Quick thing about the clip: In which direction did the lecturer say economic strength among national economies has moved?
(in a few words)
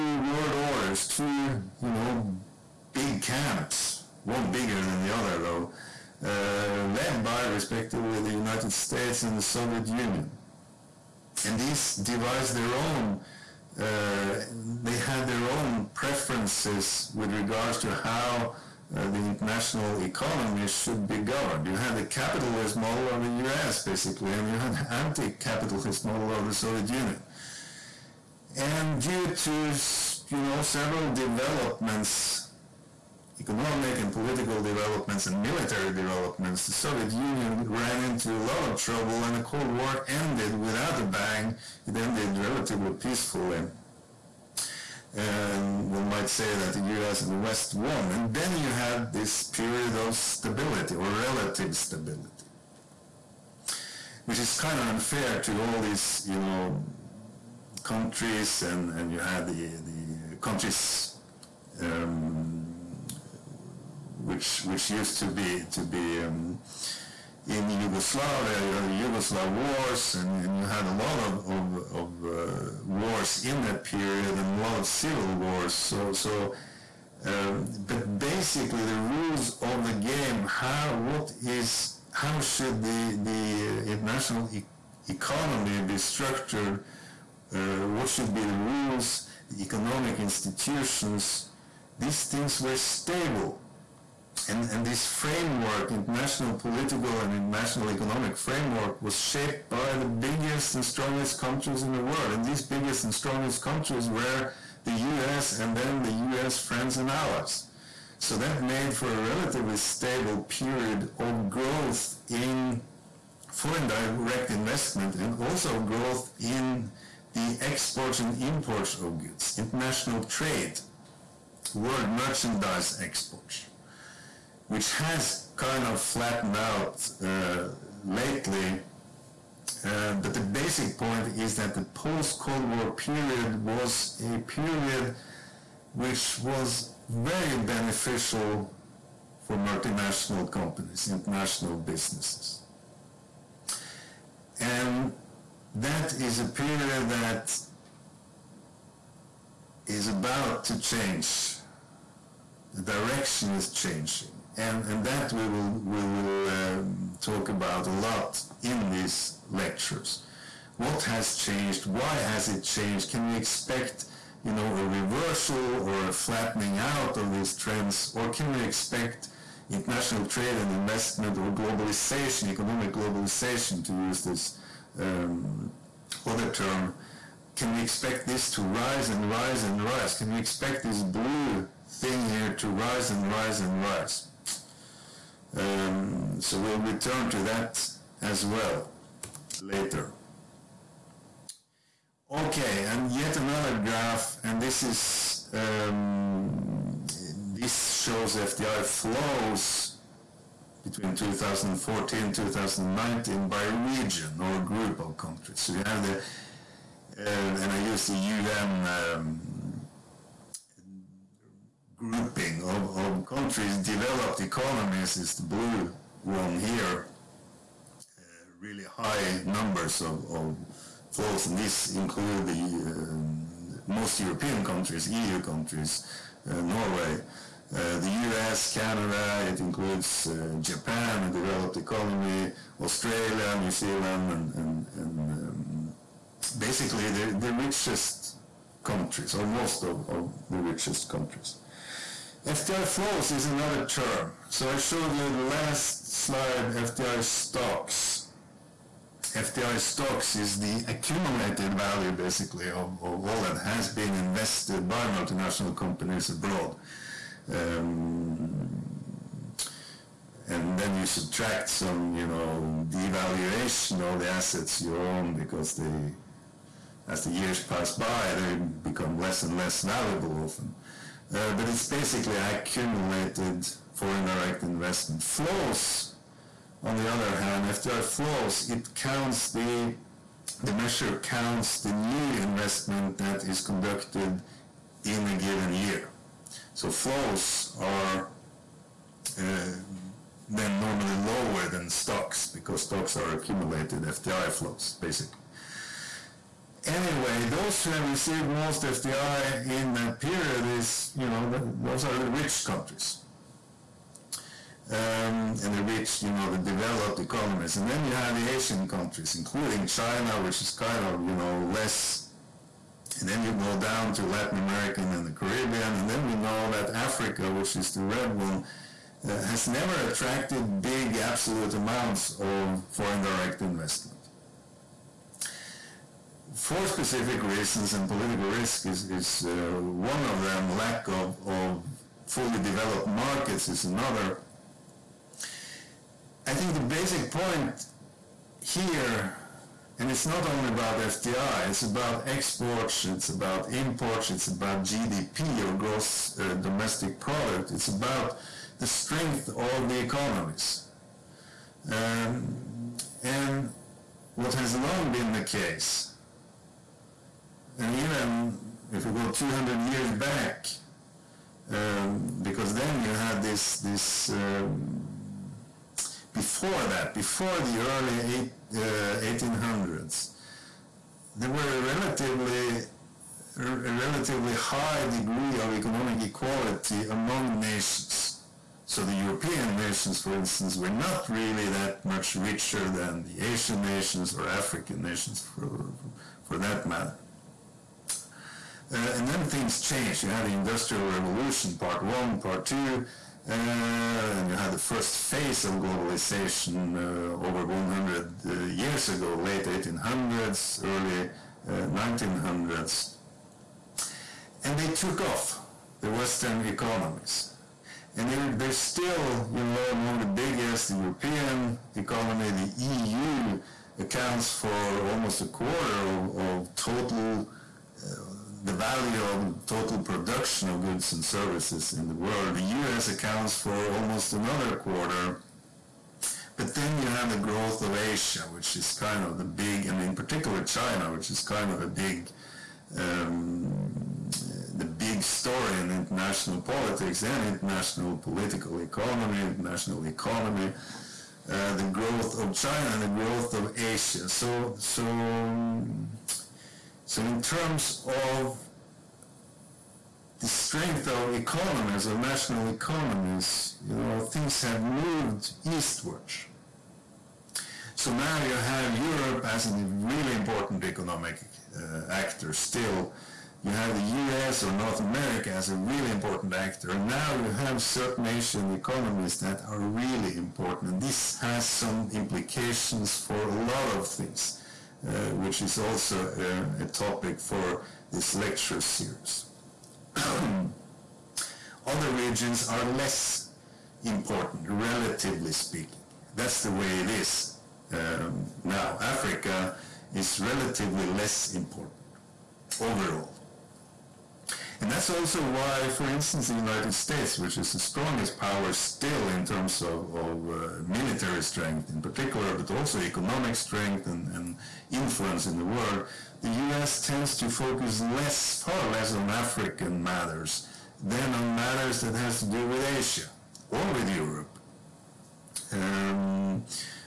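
Eastward.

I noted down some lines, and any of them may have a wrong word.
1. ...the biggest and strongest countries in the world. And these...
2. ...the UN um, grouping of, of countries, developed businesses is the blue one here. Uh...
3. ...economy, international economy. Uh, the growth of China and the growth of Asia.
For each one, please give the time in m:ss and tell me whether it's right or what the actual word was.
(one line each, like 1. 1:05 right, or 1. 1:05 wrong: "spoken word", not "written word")
1. 1:39 right
2. 3:28 wrong: "economies", not "businesses"
3. 7:18 right.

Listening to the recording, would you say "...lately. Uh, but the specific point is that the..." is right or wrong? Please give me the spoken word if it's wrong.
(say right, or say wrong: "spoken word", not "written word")
wrong: "basic", not "specific".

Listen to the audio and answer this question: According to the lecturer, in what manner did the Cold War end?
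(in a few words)
Without a bang.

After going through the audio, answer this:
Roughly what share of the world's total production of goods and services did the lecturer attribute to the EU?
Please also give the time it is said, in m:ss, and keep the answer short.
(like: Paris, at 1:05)
Almost a quarter, at 6:55.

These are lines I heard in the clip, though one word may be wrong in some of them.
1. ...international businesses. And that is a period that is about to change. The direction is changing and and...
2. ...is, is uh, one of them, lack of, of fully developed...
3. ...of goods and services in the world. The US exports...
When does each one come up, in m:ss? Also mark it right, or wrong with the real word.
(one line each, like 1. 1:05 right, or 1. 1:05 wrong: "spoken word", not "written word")
1. 2:21 right
2. 5:28 right
3. 7:00 wrong: "accounts", not "exports".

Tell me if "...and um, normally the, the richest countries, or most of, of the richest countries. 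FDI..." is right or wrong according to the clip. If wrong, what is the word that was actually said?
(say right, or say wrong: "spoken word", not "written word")
wrong: "basically", not "normally".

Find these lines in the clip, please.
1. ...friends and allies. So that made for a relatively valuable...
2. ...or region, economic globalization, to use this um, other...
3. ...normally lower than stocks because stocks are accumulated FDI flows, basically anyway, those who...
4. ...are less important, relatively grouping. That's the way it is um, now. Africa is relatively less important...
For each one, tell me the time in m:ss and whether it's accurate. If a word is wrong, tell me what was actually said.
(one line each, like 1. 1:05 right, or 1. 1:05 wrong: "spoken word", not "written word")
1. 1:46 wrong: "stable", not "valuable"
2. 2:51 wrong: "globalization", not "region"
3. 4:50 right
4. 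8:02 wrong: "speaking", not "grouping".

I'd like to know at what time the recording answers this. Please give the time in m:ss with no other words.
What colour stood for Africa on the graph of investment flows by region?
5:18.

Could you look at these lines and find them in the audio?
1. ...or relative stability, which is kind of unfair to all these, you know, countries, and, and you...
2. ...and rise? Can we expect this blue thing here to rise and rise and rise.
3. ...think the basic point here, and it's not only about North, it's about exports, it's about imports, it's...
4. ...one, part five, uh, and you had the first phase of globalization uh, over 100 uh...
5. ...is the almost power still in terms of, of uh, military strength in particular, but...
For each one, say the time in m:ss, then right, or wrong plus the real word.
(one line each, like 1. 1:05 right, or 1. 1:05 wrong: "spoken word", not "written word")
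1. 0:50 right
2. 2:59 right
3. 5:36 wrong: "FDI", not "North"
4. 6:32 wrong: "two", not "five"
5. 8:17 wrong: "strongest", not "almost".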